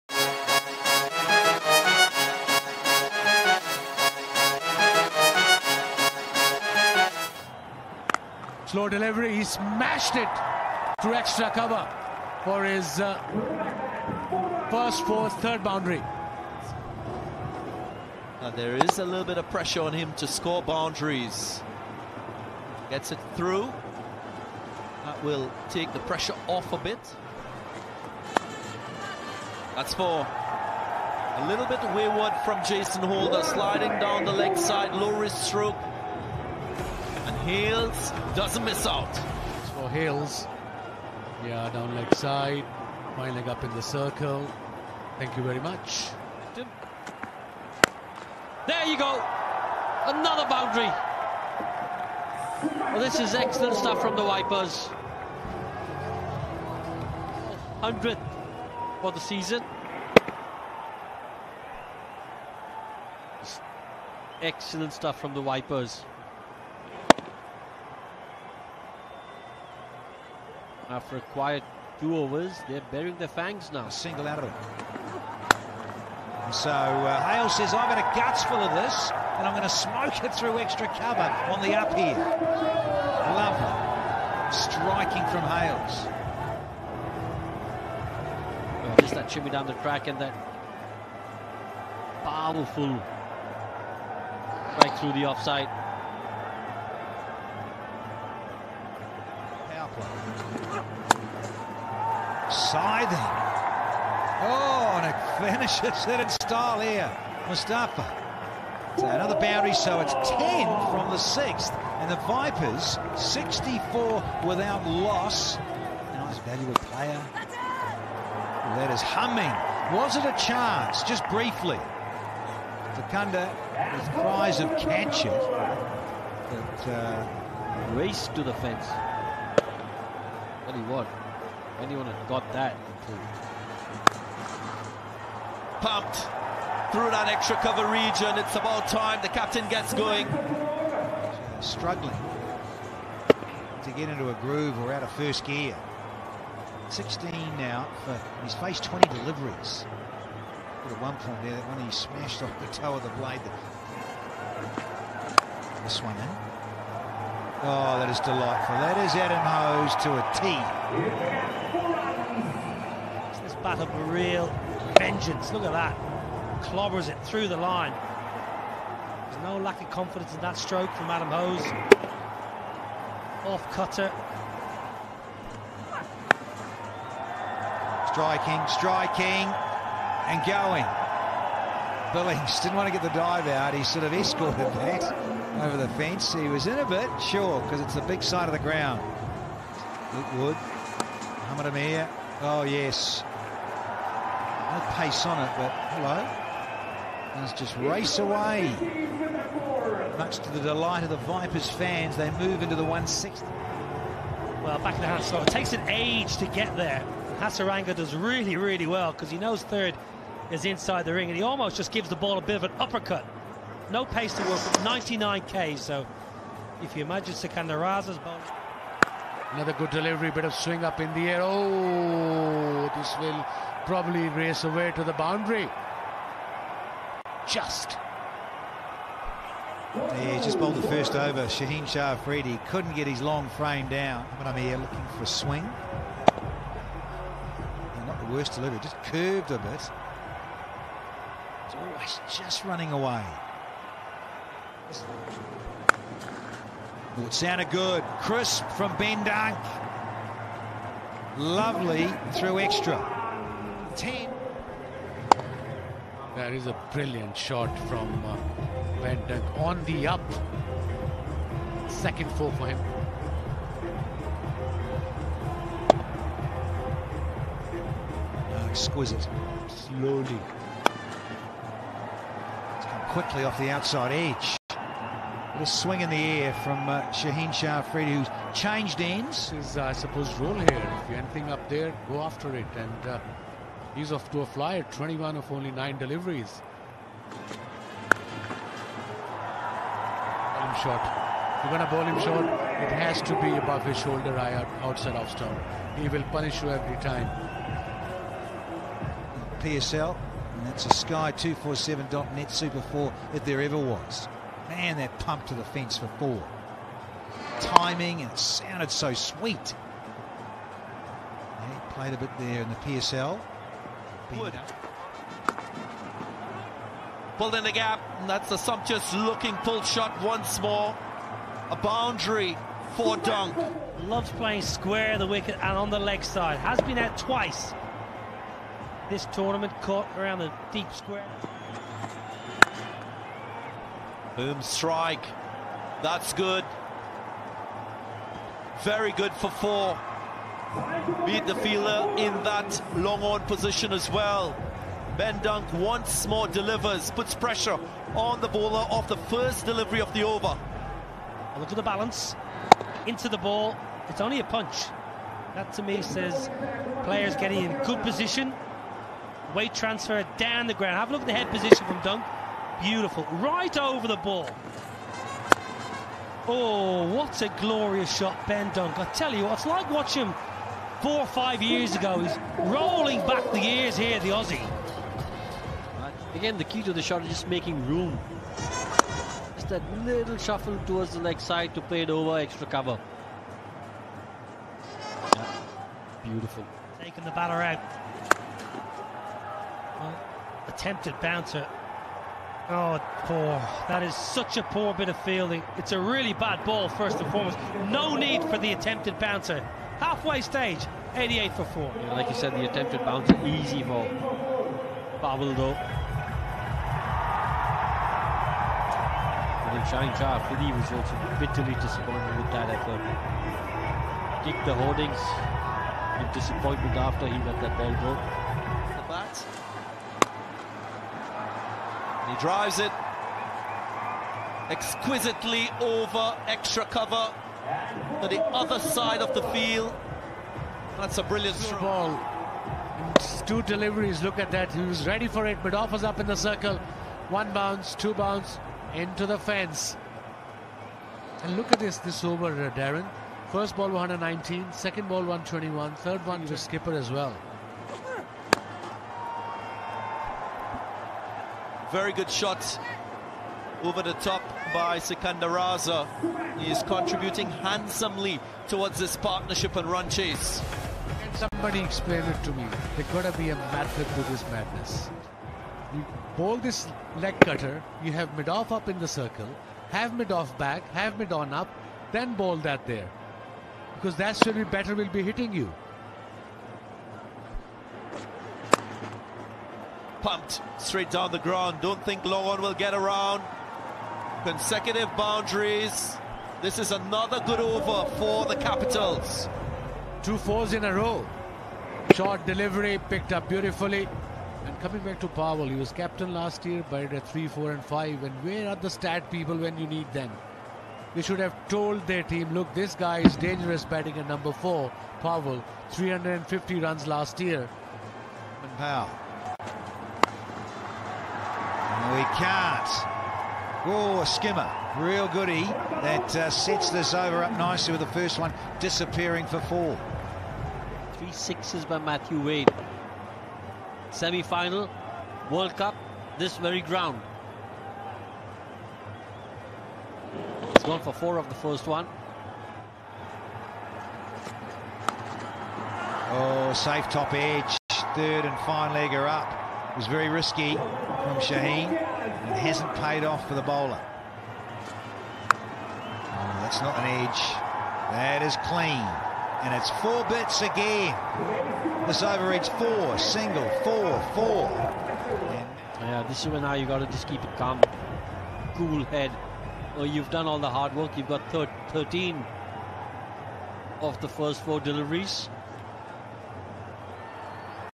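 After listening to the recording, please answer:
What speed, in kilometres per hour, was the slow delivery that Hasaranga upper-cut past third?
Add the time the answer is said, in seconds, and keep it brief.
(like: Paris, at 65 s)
99, at 214 s.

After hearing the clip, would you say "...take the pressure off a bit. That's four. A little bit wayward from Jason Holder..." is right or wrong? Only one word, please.
right.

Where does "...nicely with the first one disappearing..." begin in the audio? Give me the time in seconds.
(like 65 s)
517 s.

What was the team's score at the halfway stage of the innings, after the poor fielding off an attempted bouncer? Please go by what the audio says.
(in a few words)
88 for 4.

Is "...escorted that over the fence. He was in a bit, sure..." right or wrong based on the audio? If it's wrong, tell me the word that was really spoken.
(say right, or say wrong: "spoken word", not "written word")
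right.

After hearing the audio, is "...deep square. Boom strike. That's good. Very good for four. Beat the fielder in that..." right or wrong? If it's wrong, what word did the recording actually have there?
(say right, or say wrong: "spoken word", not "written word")
right.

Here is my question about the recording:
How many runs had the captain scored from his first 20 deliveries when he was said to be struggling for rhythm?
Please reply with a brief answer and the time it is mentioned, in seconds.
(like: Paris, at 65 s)
16, at 146 s.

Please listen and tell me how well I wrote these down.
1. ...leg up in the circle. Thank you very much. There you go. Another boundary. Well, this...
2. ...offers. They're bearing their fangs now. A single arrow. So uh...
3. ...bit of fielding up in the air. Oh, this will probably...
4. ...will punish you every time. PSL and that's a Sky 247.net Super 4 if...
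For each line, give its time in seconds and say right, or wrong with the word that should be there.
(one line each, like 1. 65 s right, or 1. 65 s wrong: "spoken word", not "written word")
1. 43 s right
2. 72 s wrong: "overs", not "offers"
3. 220 s wrong: "swing", not "fielding"
4. 296 s right.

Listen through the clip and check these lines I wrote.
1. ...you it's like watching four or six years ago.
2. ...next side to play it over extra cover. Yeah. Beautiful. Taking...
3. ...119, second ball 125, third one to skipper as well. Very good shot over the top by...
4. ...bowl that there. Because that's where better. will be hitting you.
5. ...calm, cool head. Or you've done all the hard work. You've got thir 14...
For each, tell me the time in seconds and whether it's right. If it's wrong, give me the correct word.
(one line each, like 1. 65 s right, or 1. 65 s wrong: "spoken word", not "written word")
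1. 369 s wrong: "five", not "six"
2. 381 s right
3. 443 s wrong: "121", not "125"
4. 472 s right
5. 557 s wrong: "13", not "14".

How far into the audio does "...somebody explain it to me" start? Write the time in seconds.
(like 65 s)
461 s.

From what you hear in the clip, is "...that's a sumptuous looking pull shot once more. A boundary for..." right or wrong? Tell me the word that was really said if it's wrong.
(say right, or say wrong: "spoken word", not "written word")
right.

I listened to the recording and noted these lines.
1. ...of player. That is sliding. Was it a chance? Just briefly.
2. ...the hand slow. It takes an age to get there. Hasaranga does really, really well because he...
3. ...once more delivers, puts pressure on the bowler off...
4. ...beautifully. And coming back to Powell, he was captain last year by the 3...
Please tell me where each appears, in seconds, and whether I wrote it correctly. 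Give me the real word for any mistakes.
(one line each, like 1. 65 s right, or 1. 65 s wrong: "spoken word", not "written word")
1. 116 s wrong: "humming", not "sliding"
2. 205 s right
3. 345 s right
4. 493 s right.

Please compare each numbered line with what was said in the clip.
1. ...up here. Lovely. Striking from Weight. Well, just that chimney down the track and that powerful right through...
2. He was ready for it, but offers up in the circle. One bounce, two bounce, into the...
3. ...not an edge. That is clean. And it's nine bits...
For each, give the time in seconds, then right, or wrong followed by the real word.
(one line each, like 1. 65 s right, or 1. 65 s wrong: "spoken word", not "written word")
1. 81 s wrong: "Hales", not "Weight"
2. 434 s right
3. 546 s wrong: "four", not "nine".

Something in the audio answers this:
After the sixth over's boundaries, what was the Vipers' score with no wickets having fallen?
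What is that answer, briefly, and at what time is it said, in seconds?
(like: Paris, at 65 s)
64, at 113 s.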